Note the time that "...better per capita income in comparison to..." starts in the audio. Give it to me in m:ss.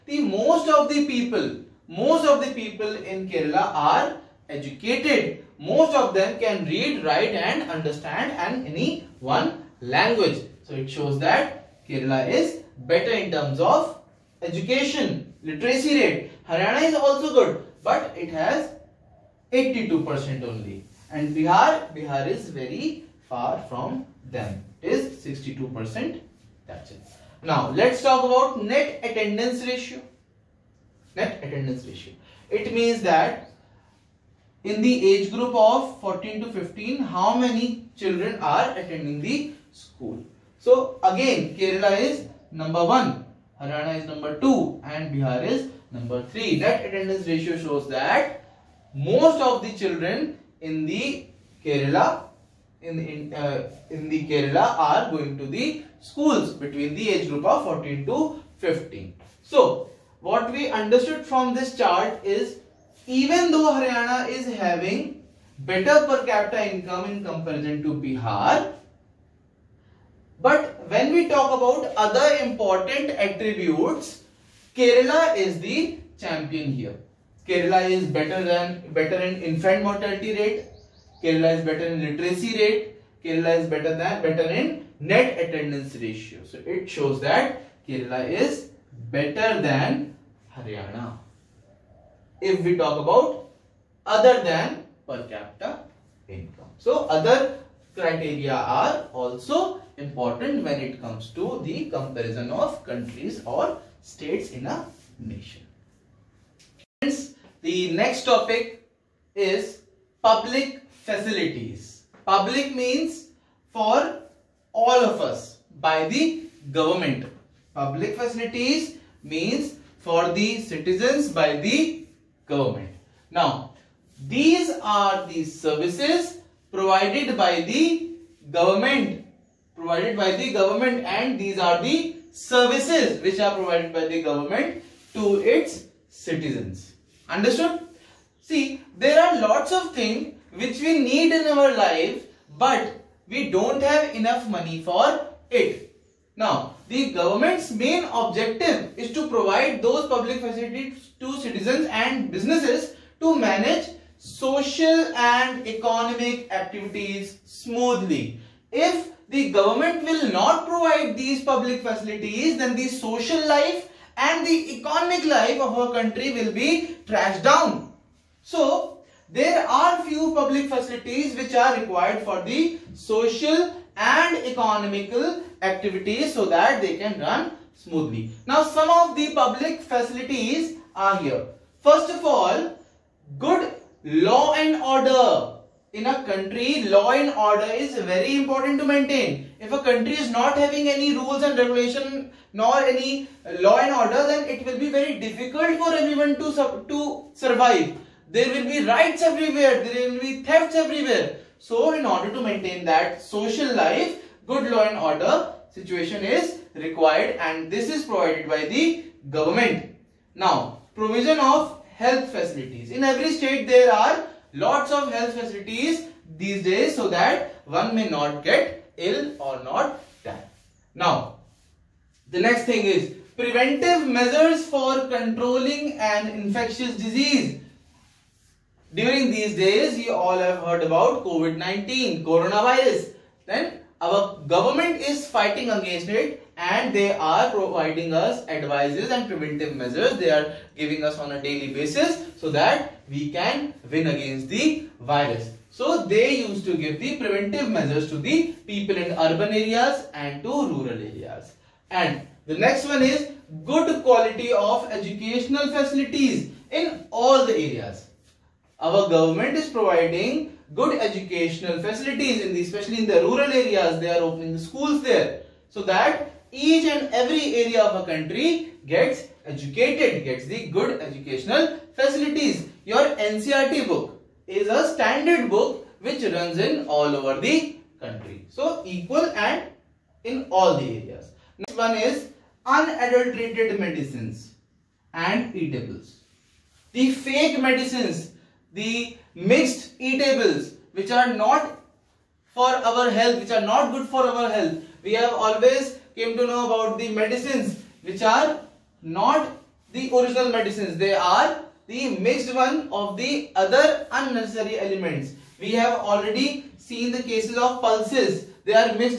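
1:05.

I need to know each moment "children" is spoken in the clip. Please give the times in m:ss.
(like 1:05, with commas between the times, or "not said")
0:37, 0:49.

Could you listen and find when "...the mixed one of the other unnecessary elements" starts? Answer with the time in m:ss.
5:01.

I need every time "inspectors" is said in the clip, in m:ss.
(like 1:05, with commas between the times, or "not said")
not said.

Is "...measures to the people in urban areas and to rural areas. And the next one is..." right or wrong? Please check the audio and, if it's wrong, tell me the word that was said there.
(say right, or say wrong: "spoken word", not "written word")
right.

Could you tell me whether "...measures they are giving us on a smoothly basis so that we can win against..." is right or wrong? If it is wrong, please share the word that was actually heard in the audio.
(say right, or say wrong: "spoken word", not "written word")
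wrong: "daily", not "smoothly".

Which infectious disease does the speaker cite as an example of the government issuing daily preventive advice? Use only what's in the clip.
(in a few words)
COVID-19.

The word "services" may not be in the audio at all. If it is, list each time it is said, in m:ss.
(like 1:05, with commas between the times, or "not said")
2:05, 2:12.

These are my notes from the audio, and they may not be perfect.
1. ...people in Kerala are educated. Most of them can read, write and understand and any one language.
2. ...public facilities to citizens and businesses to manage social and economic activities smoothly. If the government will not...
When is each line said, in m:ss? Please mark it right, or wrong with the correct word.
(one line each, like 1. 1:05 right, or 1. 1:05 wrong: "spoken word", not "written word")
1. 0:02 right
2. 2:30 right.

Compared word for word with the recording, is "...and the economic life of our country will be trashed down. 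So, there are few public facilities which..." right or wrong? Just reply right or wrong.
right.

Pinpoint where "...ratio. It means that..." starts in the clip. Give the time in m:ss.
0:31.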